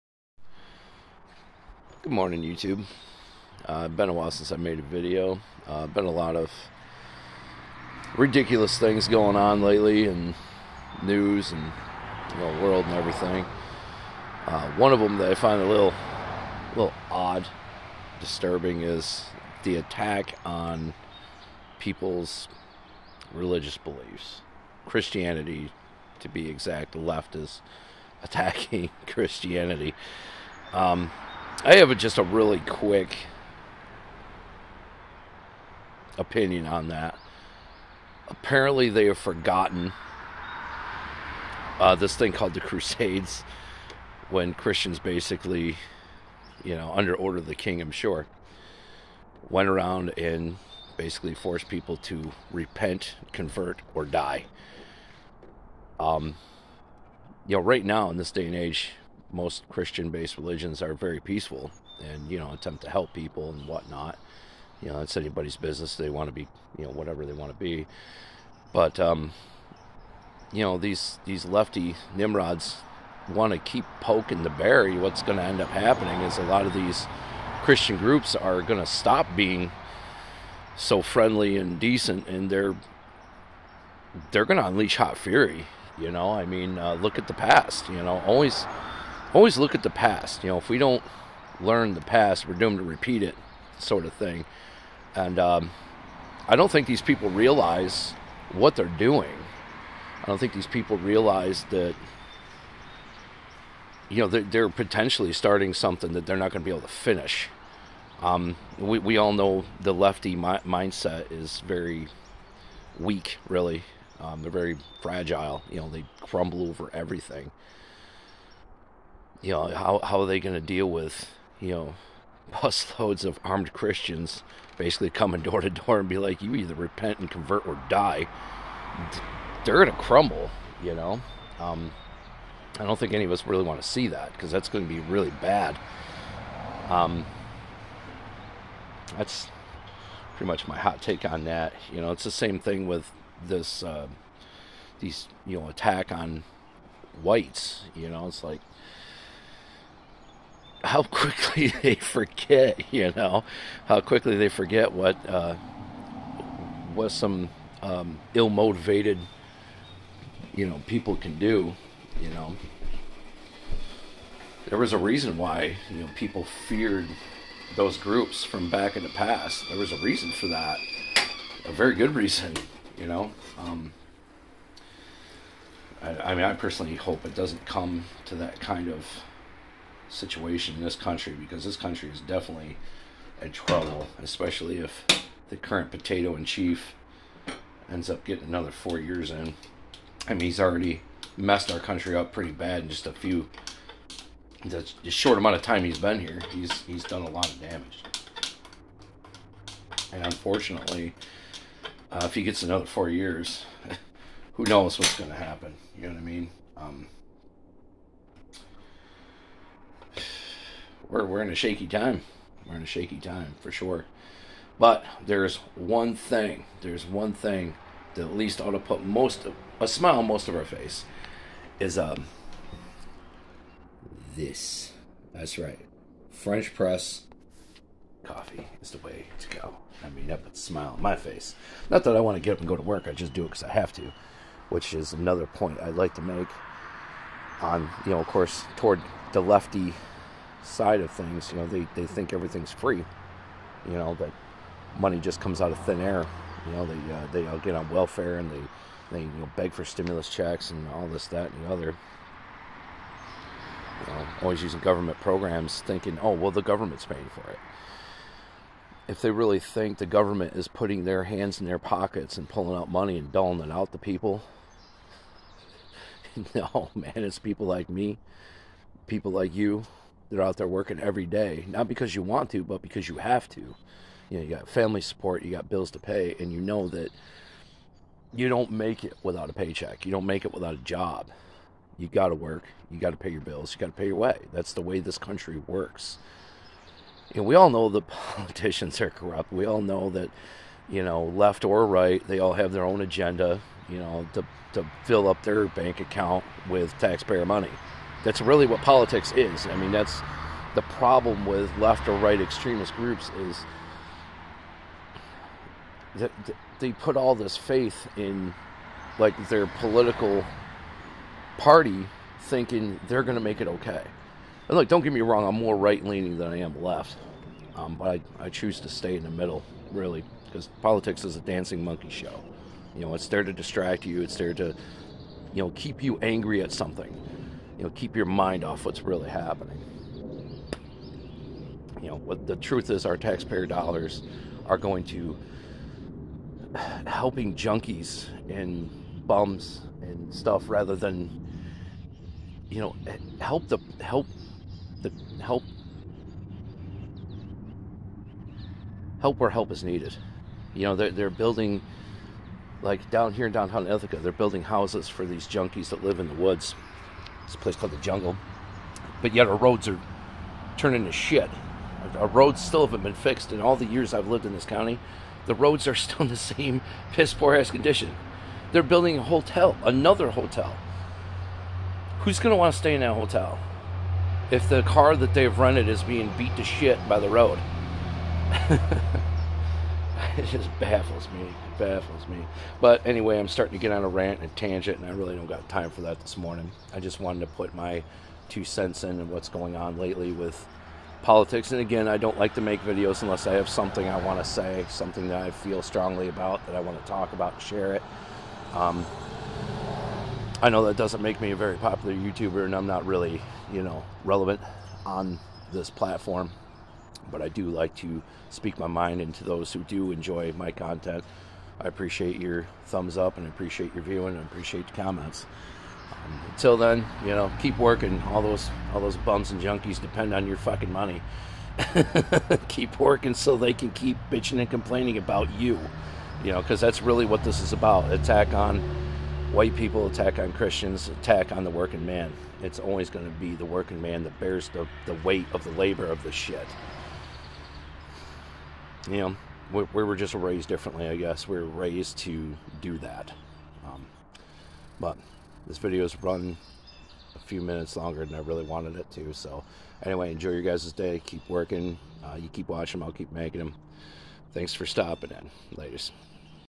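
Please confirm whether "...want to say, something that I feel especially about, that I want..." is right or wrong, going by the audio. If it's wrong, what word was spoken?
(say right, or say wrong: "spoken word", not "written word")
wrong: "strongly", not "especially".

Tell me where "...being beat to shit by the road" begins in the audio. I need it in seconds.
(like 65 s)
376 s.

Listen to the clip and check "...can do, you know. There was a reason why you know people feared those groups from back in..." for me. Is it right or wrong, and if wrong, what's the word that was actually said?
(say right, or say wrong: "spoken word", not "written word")
right.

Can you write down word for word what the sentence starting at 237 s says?
On you know, of course, toward the lefty side of things.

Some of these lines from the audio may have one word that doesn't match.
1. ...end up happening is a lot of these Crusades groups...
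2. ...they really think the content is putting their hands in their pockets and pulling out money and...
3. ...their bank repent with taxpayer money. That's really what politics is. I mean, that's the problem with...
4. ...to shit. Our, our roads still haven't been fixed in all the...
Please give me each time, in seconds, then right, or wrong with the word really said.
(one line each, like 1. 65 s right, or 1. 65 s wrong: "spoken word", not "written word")
1. 75 s wrong: "Christian", not "Crusades"
2. 259 s wrong: "government", not "content"
3. 295 s wrong: "account", not "repent"
4. 361 s right.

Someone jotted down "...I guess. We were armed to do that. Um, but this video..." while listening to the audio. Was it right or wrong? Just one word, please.
wrong.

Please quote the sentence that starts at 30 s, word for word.
Um, I have a, just a really quick opinion on that.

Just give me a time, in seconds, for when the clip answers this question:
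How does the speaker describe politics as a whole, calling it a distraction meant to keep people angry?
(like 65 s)
321 s.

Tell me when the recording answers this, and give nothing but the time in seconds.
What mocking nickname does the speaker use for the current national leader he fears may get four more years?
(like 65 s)
185 s.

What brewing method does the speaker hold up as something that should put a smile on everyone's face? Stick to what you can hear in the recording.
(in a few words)
French press.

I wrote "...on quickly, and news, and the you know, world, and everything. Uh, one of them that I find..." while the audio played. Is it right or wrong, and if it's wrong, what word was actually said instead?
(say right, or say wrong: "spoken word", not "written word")
wrong: "lately", not "quickly".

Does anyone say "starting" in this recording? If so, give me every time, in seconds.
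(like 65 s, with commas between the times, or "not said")
105 s, 383 s.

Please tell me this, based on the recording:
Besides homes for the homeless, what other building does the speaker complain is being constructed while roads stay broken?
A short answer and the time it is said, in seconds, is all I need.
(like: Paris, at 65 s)
another hotel, at 369 s.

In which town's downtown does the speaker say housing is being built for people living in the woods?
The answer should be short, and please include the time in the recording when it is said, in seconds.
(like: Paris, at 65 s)
Ithaca, at 353 s.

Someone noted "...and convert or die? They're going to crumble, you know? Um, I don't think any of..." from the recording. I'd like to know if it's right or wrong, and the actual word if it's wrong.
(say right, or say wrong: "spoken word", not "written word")
right.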